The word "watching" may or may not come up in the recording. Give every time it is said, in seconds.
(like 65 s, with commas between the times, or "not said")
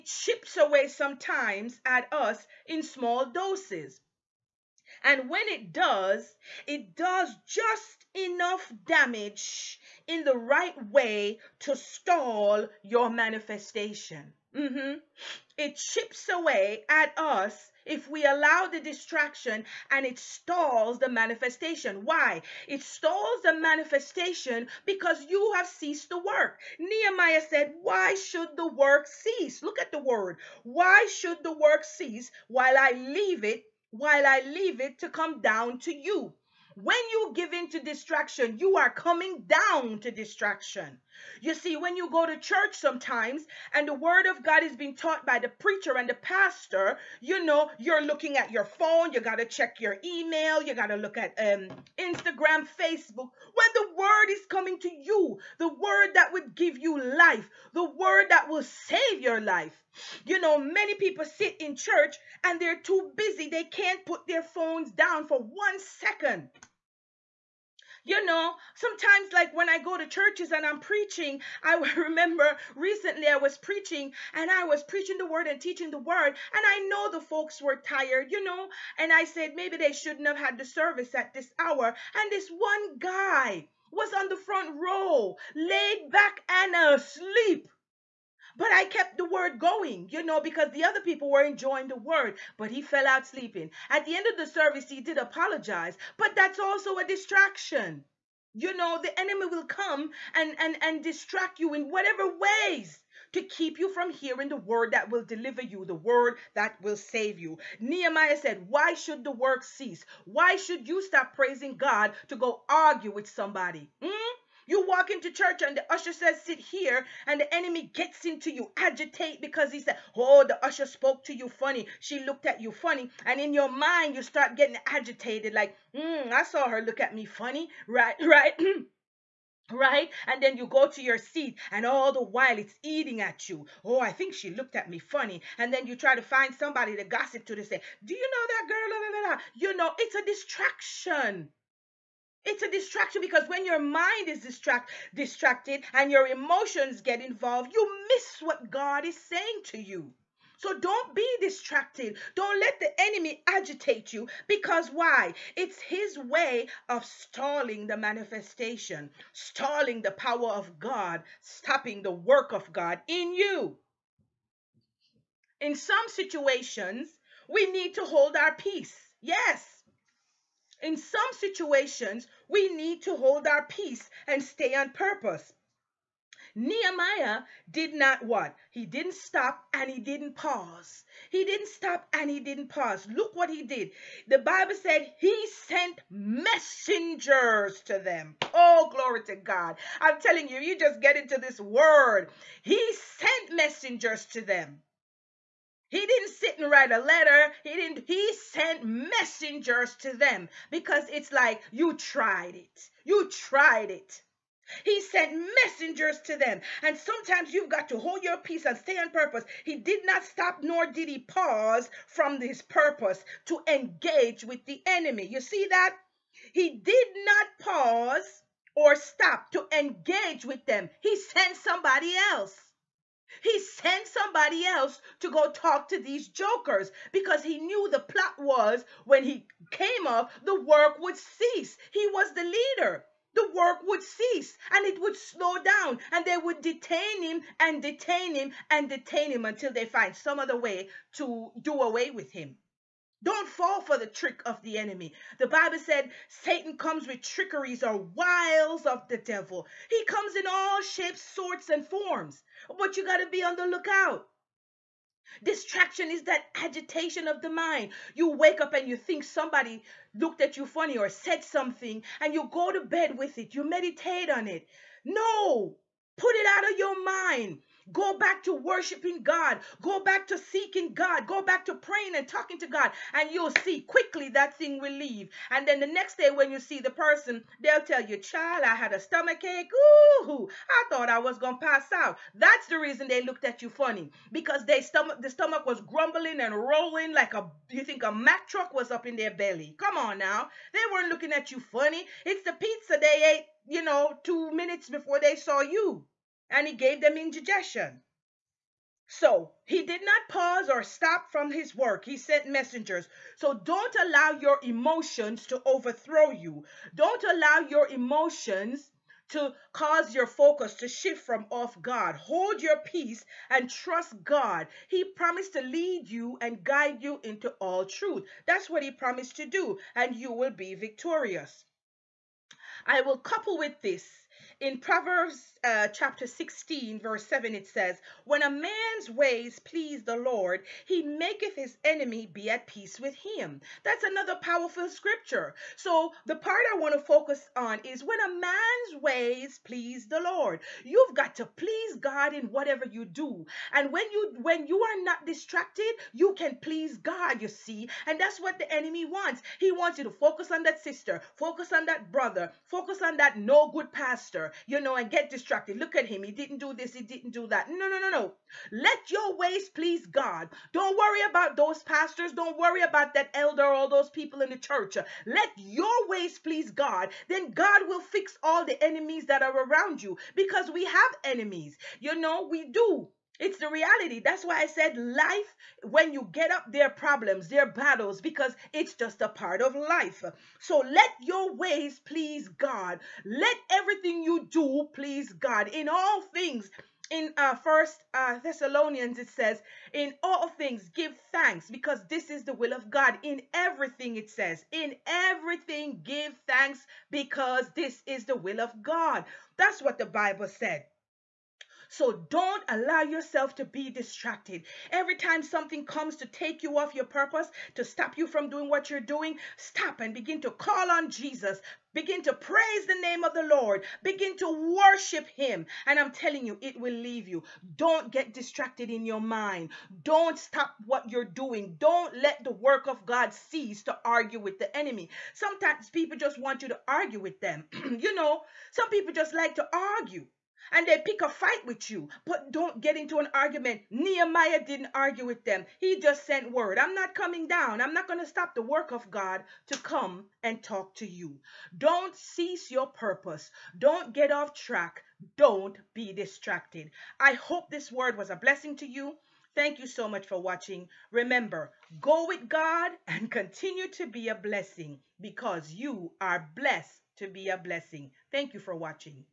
450 s, 458 s.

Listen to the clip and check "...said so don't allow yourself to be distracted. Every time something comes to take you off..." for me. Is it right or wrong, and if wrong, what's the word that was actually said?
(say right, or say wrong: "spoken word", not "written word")
right.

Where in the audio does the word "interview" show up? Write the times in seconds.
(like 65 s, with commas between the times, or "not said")
not said.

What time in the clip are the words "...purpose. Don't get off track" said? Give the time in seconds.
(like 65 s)
442 s.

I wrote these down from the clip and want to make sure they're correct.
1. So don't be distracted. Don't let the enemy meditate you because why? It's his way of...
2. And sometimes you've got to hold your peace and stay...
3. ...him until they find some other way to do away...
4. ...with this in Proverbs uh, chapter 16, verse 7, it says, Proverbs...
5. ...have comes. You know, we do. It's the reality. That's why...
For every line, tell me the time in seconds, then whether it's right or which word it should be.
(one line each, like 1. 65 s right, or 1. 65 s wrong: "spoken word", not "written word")
1. 150 s wrong: "agitate", not "meditate"
2. 206 s right
3. 239 s right
4. 323 s wrong: "When", not "Proverbs"
5. 370 s wrong: "enemies", not "comes".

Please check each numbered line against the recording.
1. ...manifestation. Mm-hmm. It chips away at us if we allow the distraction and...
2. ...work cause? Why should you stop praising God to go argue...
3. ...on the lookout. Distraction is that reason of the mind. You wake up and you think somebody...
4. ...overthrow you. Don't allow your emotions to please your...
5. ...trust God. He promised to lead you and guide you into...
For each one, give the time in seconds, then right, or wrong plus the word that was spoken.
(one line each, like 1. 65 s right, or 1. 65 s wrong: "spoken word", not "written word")
1. 13 s right
2. 109 s wrong: "cease", not "cause"
3. 253 s wrong: "agitation", not "reason"
4. 305 s wrong: "cause", not "please"
5. 313 s right.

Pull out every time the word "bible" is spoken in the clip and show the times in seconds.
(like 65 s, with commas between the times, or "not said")
184 s, 245 s, 400 s.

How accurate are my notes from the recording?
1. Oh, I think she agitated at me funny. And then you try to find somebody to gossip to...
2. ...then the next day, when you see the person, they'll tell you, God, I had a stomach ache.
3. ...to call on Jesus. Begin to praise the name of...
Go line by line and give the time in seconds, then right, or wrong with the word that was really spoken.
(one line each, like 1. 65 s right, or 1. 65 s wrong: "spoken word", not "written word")
1. 133 s wrong: "looked", not "agitated"
2. 275 s wrong: "Child", not "God"
3. 410 s right.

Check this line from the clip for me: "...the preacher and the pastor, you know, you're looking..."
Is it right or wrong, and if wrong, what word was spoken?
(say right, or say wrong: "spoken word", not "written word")
right.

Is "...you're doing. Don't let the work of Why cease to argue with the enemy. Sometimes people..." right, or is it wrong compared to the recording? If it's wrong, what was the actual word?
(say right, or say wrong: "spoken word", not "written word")
wrong: "God", not "Why".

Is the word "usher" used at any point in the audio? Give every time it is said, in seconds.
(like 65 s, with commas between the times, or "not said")
115 s, 120 s.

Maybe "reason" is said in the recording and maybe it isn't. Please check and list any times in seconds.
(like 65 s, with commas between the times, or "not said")
282 s.